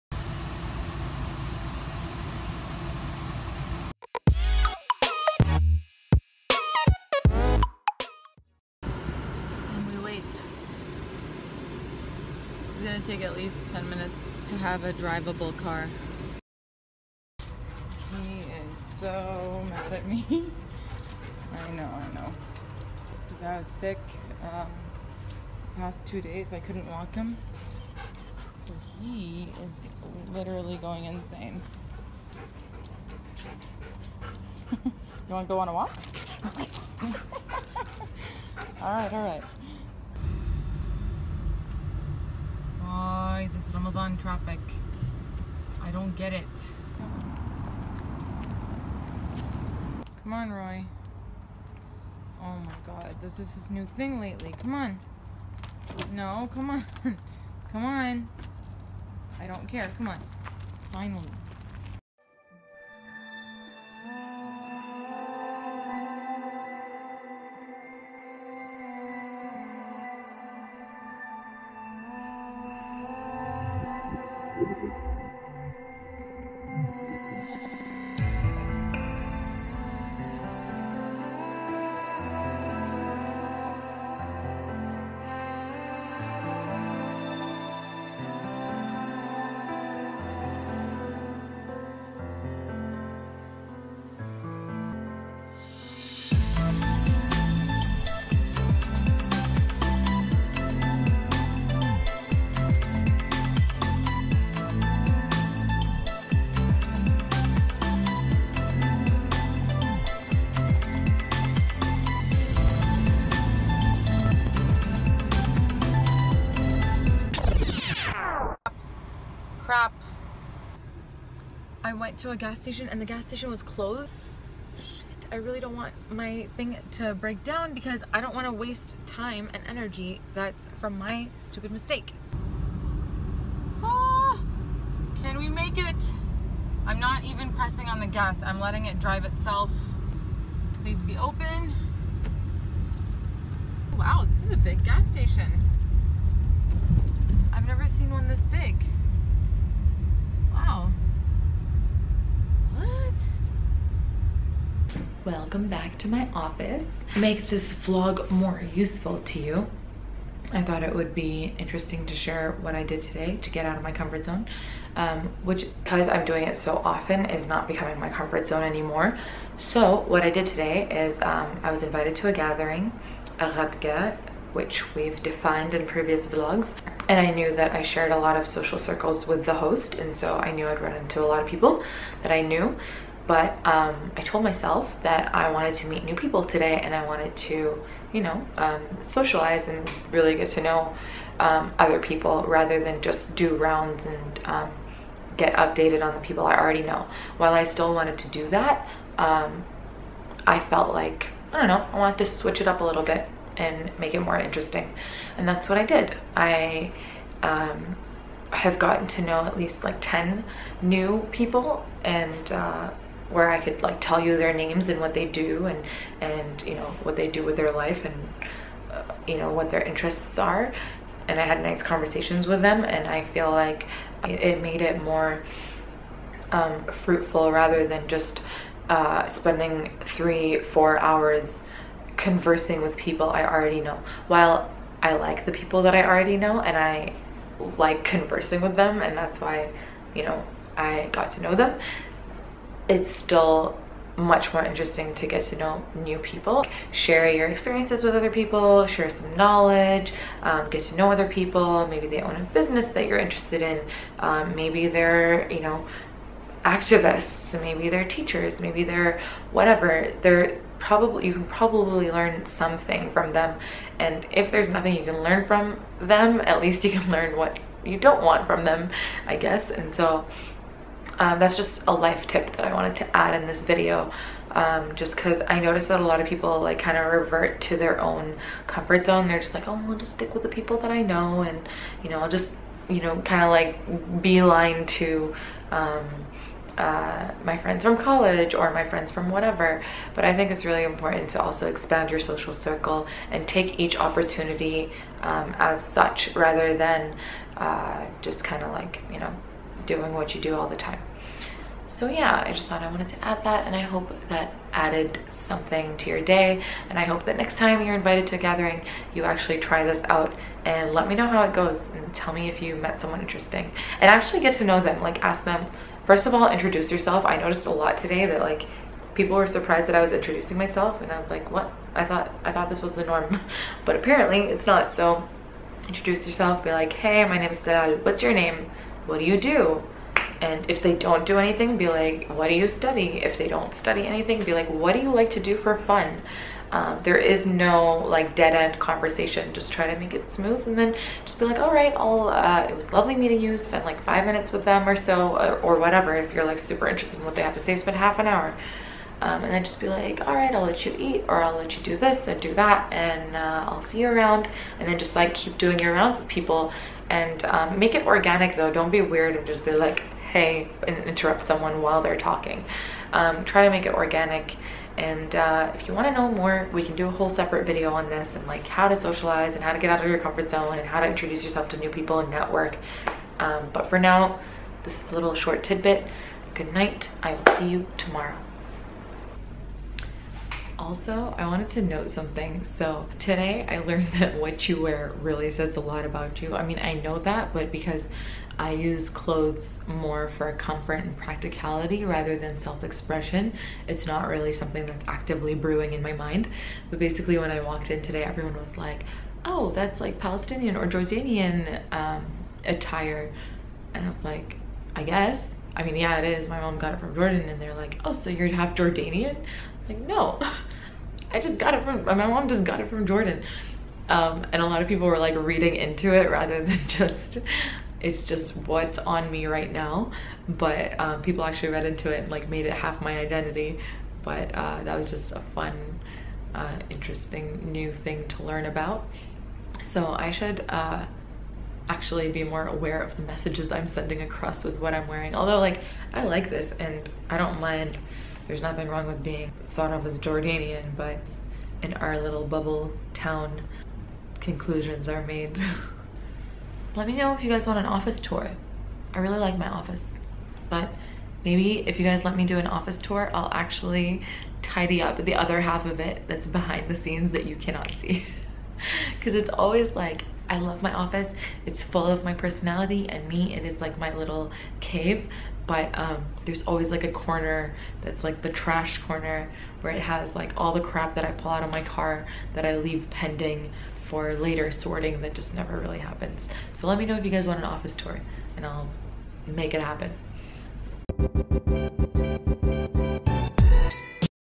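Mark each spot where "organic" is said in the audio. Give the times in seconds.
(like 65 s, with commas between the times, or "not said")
358 s, 363 s.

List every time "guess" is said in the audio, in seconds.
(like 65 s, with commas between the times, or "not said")
269 s, 405 s.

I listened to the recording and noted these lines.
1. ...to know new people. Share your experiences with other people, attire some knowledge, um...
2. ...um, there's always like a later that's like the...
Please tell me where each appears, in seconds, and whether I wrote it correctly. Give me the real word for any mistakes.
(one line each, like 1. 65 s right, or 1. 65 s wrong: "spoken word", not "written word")
1. 245 s wrong: "share", not "attire"
2. 465 s wrong: "corner", not "later".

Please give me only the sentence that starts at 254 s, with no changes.
Um, maybe they're, you know, activists, maybe they're teachers, maybe they're whatever.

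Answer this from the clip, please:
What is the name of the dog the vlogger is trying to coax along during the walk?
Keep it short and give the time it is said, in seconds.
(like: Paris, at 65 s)
Roy, at 50 s.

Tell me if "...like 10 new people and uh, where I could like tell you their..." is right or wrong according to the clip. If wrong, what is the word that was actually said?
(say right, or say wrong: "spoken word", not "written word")
right.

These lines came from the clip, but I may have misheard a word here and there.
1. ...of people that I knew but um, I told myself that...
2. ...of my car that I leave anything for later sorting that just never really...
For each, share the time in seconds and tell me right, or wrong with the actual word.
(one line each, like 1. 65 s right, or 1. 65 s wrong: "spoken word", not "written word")
1. 181 s right
2. 471 s wrong: "pending", not "anything".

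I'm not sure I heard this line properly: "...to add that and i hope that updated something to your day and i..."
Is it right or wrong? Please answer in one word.
wrong.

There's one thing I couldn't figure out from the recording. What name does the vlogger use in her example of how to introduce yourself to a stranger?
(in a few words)
Dalal.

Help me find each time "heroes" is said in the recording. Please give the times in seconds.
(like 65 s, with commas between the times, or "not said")
not said.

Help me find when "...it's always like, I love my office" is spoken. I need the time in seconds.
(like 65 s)
459 s.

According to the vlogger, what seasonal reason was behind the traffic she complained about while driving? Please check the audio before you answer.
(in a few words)
Ramadan.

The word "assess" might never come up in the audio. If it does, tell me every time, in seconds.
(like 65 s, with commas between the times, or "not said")
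not said.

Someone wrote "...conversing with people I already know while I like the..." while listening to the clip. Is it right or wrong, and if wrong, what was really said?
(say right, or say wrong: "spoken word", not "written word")
right.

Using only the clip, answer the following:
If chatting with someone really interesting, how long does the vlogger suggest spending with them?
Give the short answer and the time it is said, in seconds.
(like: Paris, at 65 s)
half an hour, at 347 s.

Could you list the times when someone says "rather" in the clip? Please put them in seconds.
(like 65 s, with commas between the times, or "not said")
192 s, 227 s, 296 s, 392 s, 416 s.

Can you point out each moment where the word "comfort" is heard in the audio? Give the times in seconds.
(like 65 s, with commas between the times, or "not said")
163 s, 168 s, 278 s, 370 s, 390 s.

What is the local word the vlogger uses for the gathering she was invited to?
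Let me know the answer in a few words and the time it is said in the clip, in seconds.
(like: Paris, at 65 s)
ghabga, at 173 s.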